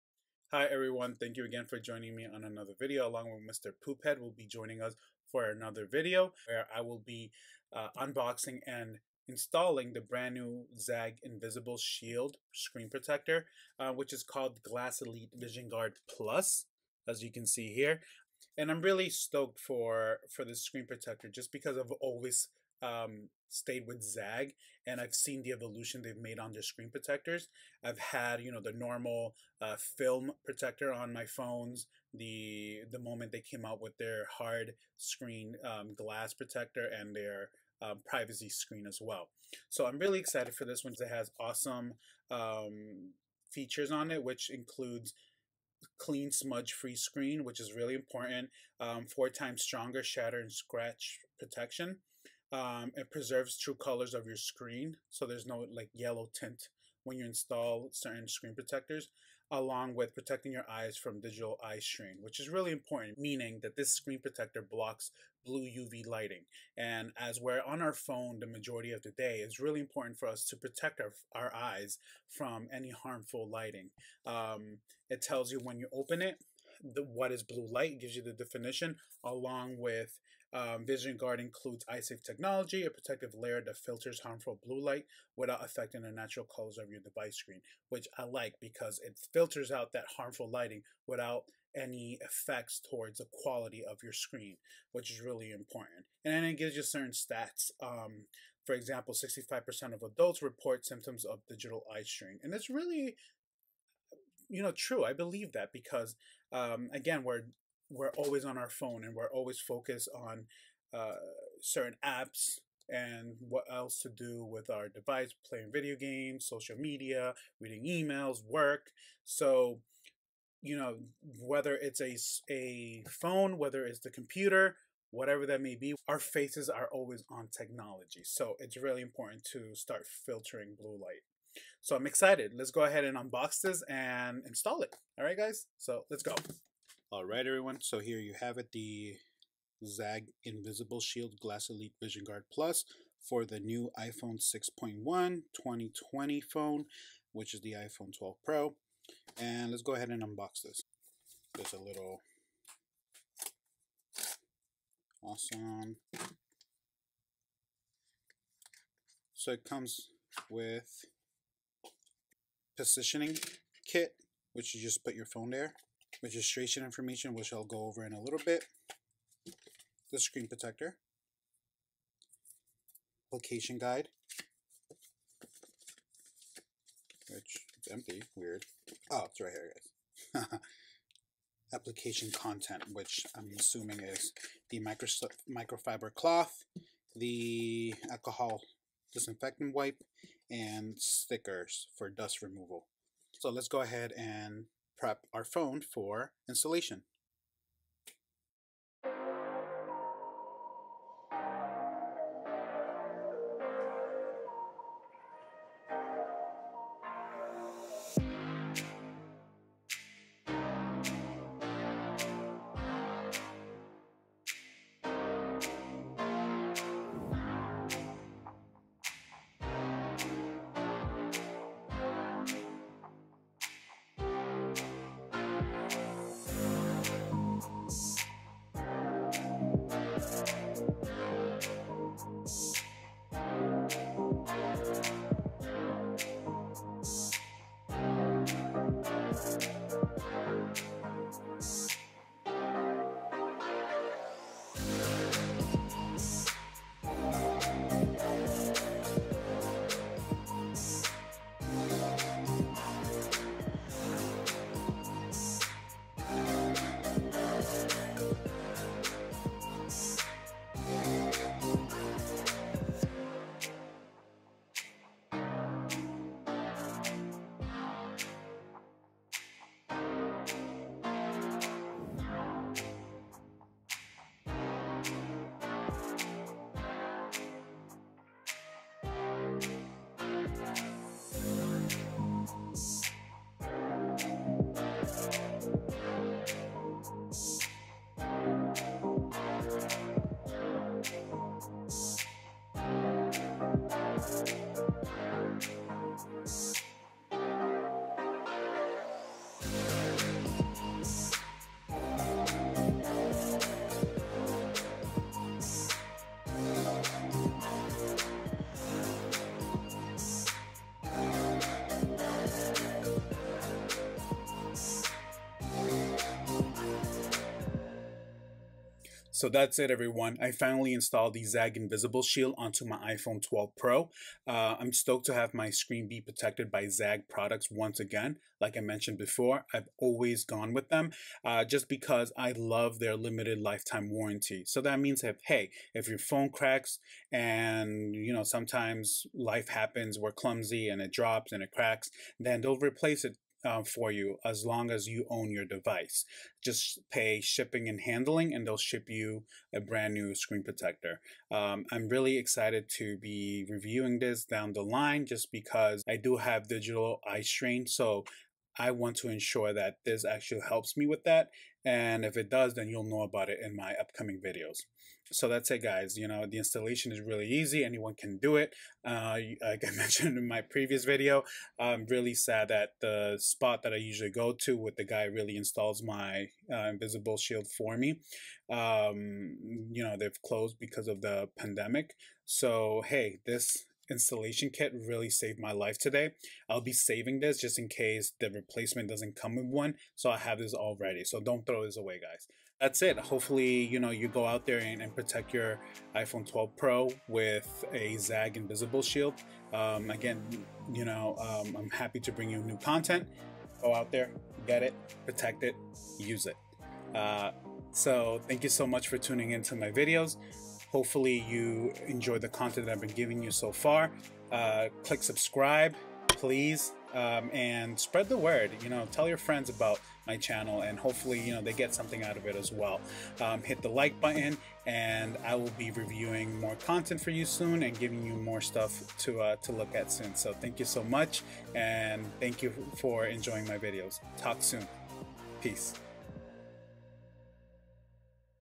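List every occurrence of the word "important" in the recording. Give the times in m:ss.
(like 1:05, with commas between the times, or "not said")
0:47, 1:02, 1:09, 1:35, 2:09.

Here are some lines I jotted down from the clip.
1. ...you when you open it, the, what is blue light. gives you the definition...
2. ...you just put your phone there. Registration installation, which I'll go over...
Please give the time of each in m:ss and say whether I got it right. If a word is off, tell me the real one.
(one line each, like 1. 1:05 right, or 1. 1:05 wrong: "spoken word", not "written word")
1. 1:15 right
2. 2:44 wrong: "information", not "installation".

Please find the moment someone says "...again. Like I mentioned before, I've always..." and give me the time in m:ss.
5:27.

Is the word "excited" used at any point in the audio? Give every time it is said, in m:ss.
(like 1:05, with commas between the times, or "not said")
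0:40, 2:12, 5:52.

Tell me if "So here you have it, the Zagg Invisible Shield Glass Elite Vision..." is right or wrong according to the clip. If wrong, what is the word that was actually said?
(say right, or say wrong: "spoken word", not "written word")
right.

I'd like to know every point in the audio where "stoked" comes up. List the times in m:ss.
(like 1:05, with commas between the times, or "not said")
0:19, 5:24.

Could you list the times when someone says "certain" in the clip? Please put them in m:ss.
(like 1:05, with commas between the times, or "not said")
0:57, 1:36, 1:51.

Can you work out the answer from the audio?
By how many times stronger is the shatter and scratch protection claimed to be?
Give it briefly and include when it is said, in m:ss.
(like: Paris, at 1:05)
4, at 0:49.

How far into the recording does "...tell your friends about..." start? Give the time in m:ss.
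6:59.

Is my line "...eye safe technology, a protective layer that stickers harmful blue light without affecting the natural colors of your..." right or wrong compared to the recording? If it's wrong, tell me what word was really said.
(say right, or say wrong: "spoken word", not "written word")
wrong: "filters", not "stickers".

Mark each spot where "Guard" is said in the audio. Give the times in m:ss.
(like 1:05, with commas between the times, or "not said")
0:15, 1:21, 2:22.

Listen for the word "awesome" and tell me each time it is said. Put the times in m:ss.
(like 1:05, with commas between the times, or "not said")
0:41, 2:35.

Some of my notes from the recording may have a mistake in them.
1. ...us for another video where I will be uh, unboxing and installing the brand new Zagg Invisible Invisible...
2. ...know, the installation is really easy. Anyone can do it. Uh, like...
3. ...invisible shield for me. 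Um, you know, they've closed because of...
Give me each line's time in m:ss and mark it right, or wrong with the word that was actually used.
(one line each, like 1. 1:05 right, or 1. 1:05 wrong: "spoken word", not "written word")
1. 0:04 wrong: "Shield", not "Invisible"
2. 6:06 right
3. 6:16 right.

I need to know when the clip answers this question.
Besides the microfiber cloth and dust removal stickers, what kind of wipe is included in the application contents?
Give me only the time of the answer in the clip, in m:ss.
3:08.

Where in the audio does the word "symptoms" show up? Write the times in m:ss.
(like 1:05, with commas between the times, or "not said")
1:40.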